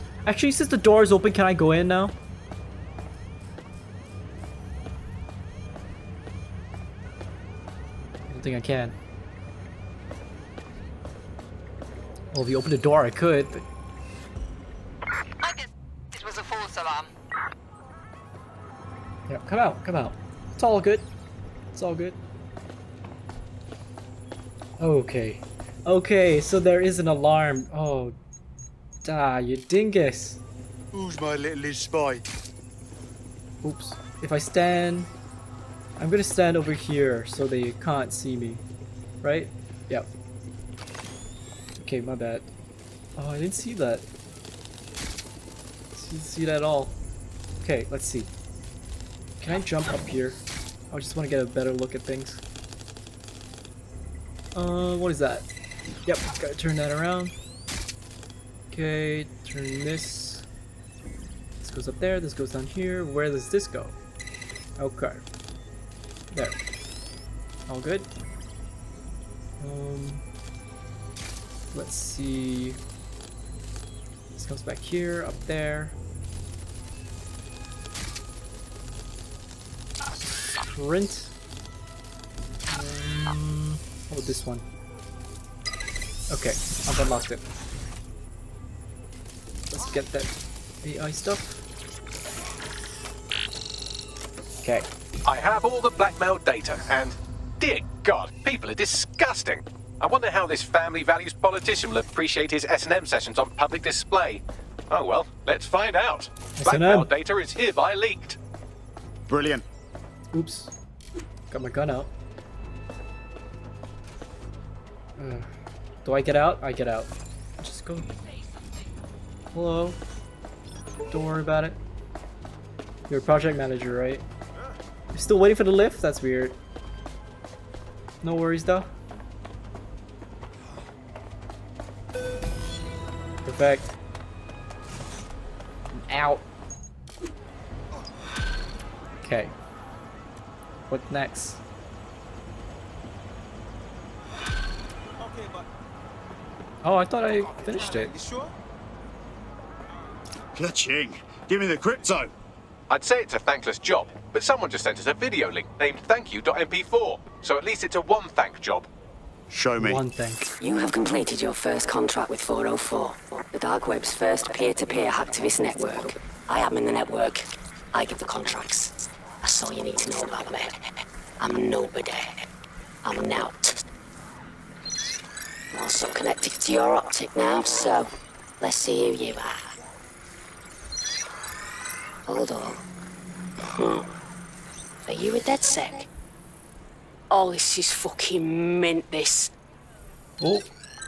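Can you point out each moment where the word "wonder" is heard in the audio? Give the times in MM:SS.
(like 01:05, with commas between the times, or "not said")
01:40.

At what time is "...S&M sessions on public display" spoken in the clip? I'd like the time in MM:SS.
01:42.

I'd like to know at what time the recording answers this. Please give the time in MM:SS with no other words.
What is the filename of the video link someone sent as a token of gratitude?
02:36.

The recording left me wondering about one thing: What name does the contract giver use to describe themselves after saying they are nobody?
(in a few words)
Nowt.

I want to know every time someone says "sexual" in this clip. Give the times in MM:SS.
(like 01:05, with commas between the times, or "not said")
not said.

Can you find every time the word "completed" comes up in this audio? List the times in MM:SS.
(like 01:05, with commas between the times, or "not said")
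02:40.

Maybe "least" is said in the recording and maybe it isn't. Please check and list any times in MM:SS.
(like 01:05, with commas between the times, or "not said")
02:37.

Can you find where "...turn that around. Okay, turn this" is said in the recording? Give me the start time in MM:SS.
00:56.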